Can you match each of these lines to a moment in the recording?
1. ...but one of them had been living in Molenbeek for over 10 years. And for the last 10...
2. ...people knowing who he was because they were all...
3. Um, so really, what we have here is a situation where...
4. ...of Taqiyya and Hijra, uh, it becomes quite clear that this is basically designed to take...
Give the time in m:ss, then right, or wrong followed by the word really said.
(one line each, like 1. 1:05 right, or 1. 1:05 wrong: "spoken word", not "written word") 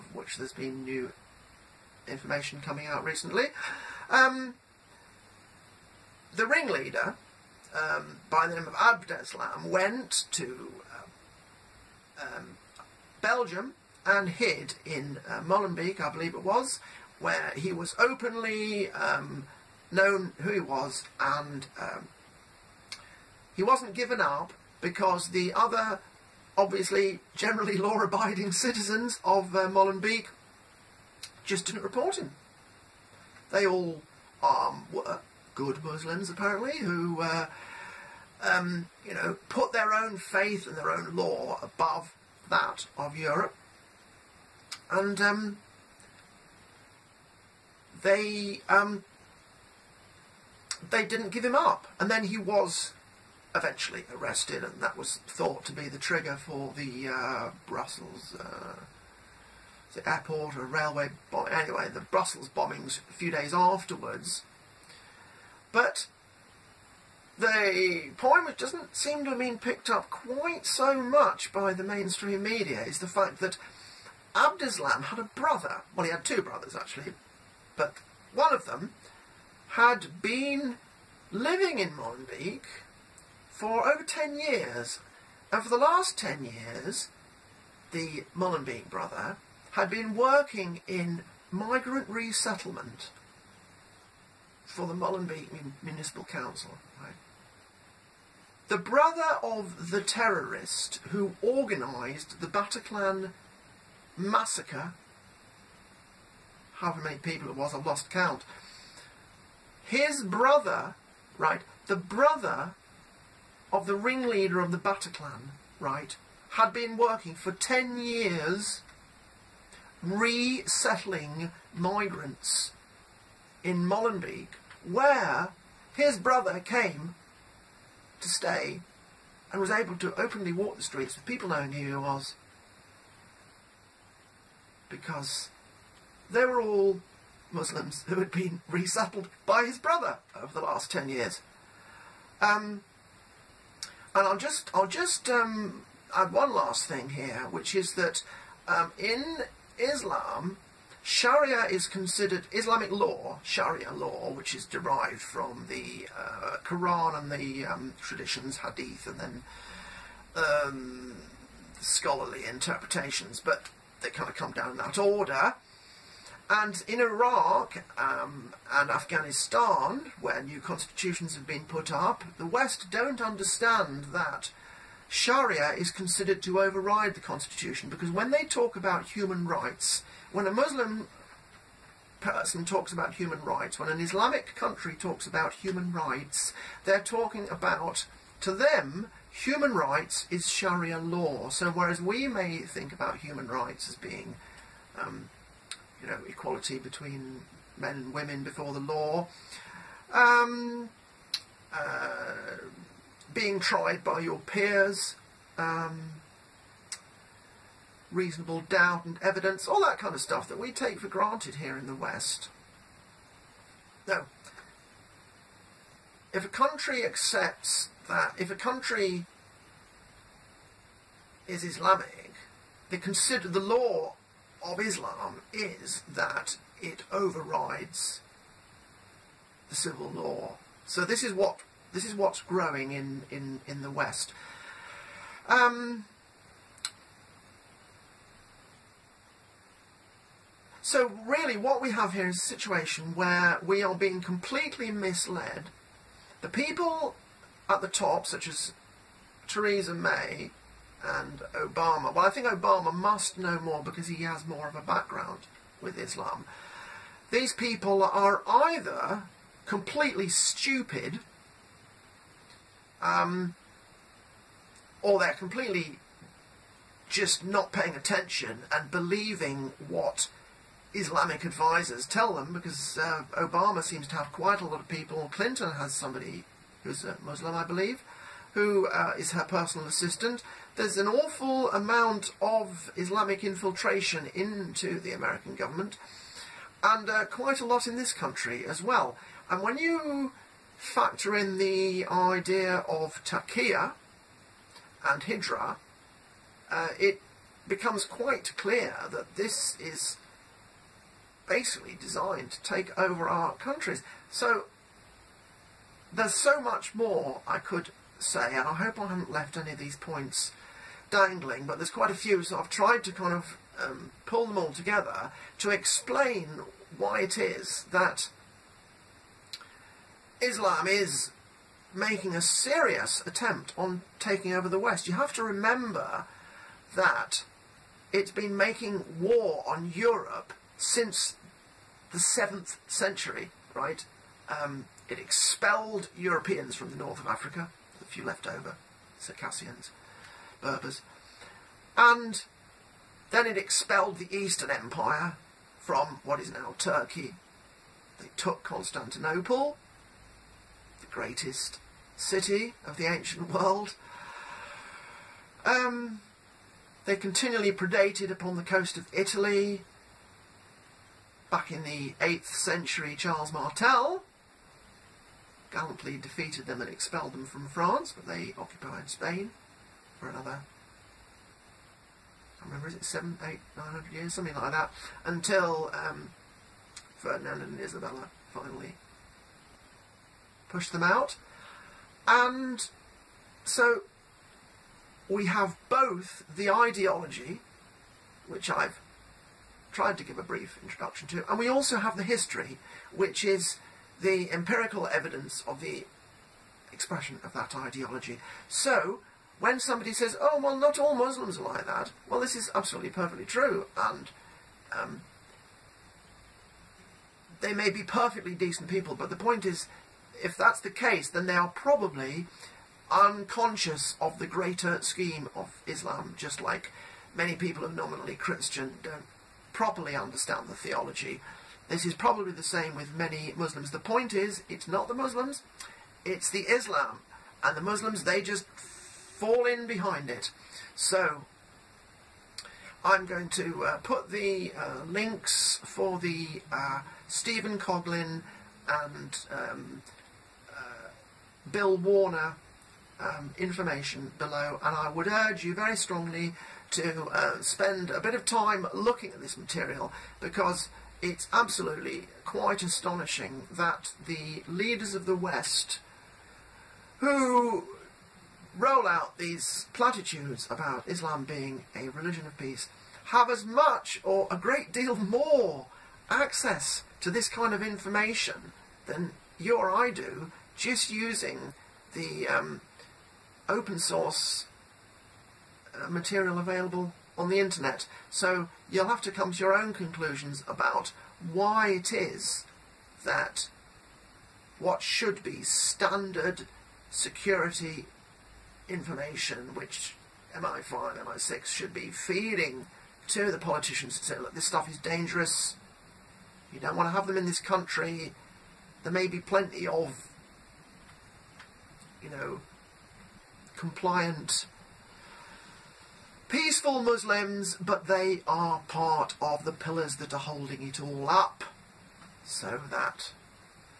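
1. 1:17 right
2. 2:11 right
3. 3:55 right
4. 4:52 right.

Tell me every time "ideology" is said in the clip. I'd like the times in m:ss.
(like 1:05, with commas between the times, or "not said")
6:26, 6:37.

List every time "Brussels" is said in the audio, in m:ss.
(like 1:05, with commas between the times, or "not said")
0:57, 1:01.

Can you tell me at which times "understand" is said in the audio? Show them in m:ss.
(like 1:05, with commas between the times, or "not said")
2:53, 7:00.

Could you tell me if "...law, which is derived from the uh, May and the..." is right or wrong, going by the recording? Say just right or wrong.
wrong.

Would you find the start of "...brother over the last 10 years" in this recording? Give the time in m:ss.
2:19.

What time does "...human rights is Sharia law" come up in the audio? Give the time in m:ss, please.
3:09.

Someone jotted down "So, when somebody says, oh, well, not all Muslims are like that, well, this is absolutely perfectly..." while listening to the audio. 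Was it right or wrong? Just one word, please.
right.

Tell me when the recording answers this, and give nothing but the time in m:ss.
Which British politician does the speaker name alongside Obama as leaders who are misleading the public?
4:09.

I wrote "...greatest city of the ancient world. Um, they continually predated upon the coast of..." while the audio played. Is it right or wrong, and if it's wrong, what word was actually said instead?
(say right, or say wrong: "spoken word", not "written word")
right.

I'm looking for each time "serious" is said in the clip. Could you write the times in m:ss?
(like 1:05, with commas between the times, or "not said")
5:22.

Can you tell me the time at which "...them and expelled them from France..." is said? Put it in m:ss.
6:06.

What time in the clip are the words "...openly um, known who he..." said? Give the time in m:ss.
0:17.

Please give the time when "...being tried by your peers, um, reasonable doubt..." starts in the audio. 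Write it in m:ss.
3:23.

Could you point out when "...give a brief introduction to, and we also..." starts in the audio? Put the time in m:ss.
6:30.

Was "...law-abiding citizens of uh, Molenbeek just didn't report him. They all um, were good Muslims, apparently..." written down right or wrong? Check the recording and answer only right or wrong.
right.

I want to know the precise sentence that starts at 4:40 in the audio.
There's an awful amount of Islamic infiltration into the American government, and uh, quite a lot in this country as well.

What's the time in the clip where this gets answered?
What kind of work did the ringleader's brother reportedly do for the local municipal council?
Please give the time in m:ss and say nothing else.
1:31.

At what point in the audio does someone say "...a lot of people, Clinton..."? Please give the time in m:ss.
4:34.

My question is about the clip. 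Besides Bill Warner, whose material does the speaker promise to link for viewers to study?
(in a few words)
Stephen Coughlin.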